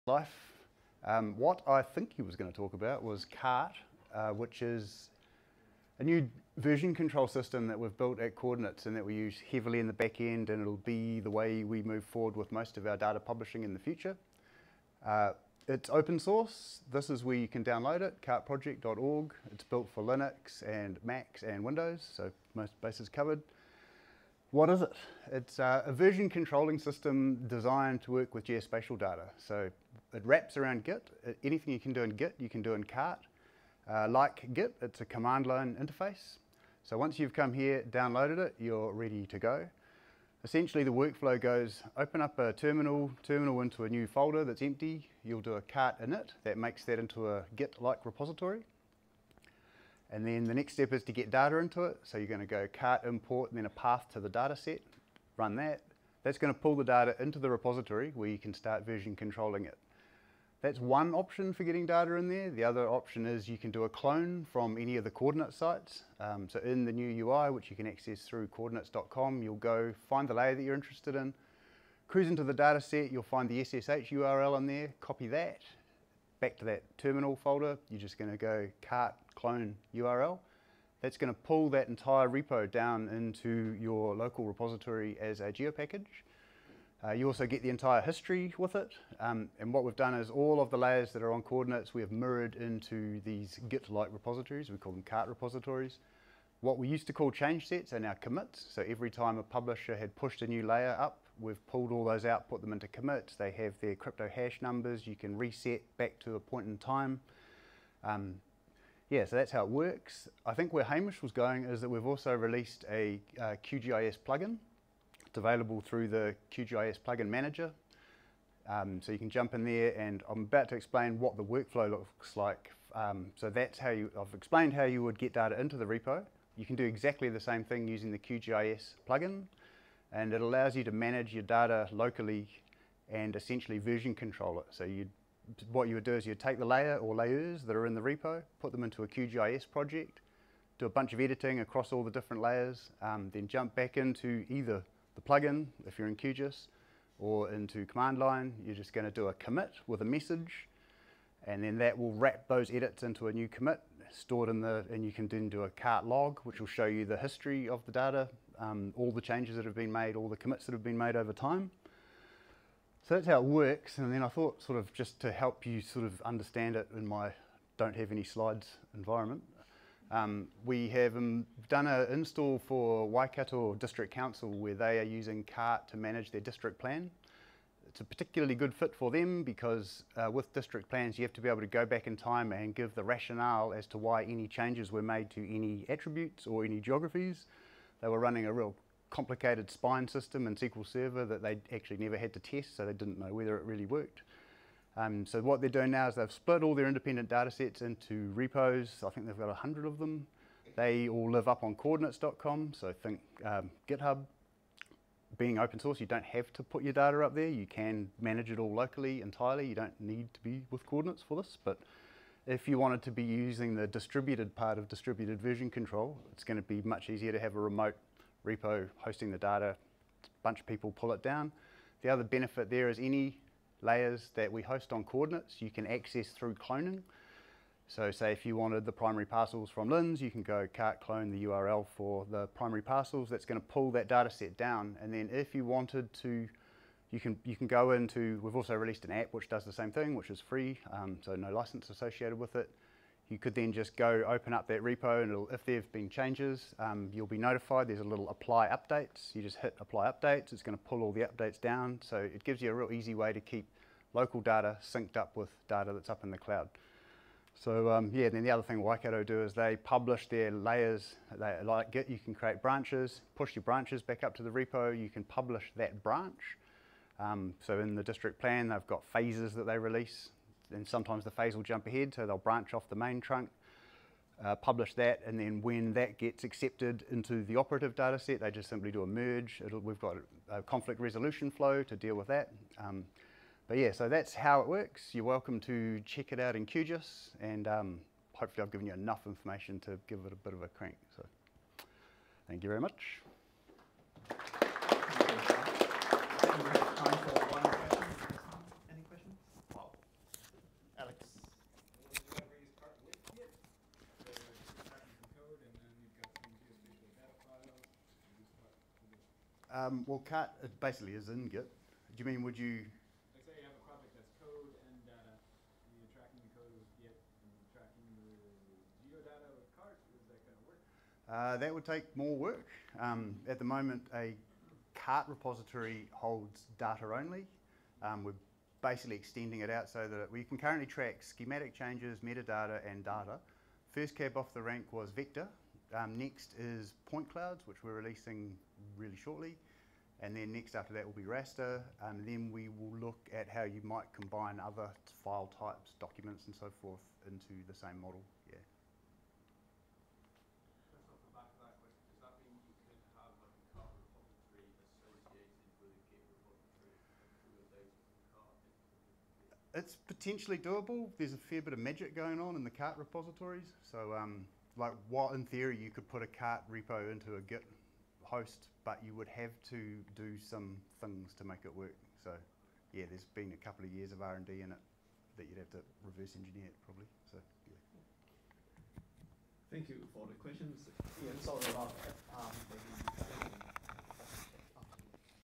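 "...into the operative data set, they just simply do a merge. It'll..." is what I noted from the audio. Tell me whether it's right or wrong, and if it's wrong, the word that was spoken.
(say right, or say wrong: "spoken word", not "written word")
right.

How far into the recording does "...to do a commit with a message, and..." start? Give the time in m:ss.
2:29.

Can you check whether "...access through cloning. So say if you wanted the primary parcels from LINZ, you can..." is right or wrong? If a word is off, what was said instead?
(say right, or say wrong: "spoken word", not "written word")
right.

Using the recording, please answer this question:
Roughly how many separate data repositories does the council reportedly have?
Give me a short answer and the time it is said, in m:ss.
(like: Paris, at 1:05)
100, at 3:19.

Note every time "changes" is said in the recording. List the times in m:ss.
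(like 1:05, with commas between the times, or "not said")
1:37, 2:39, 3:04, 4:06, 5:31.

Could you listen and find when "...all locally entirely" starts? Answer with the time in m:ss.
3:28.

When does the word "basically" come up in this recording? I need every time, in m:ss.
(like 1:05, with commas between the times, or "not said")
5:10, 5:28.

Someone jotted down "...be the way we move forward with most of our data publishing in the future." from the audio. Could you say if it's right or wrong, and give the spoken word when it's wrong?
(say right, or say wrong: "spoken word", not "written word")
right.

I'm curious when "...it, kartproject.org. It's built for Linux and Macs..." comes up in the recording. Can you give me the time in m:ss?
0:18.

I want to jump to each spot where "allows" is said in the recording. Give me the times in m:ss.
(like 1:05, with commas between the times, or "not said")
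2:10.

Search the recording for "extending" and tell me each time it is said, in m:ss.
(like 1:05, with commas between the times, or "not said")
5:29.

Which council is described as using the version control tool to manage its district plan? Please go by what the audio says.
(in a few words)
Waikato District Council.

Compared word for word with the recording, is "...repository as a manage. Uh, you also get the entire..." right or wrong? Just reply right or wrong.
wrong.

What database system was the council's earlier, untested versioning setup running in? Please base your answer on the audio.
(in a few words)
SQL Server.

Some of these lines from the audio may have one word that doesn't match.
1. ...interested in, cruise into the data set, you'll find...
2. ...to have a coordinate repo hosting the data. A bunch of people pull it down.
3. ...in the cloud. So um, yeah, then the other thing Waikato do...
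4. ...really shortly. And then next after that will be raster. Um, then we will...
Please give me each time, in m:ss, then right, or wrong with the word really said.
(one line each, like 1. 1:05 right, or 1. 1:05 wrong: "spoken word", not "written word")
1. 1:10 right
2. 3:37 wrong: "remote", not "coordinate"
3. 4:16 right
4. 5:38 right.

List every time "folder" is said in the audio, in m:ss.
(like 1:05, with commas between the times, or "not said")
0:44, 1:17.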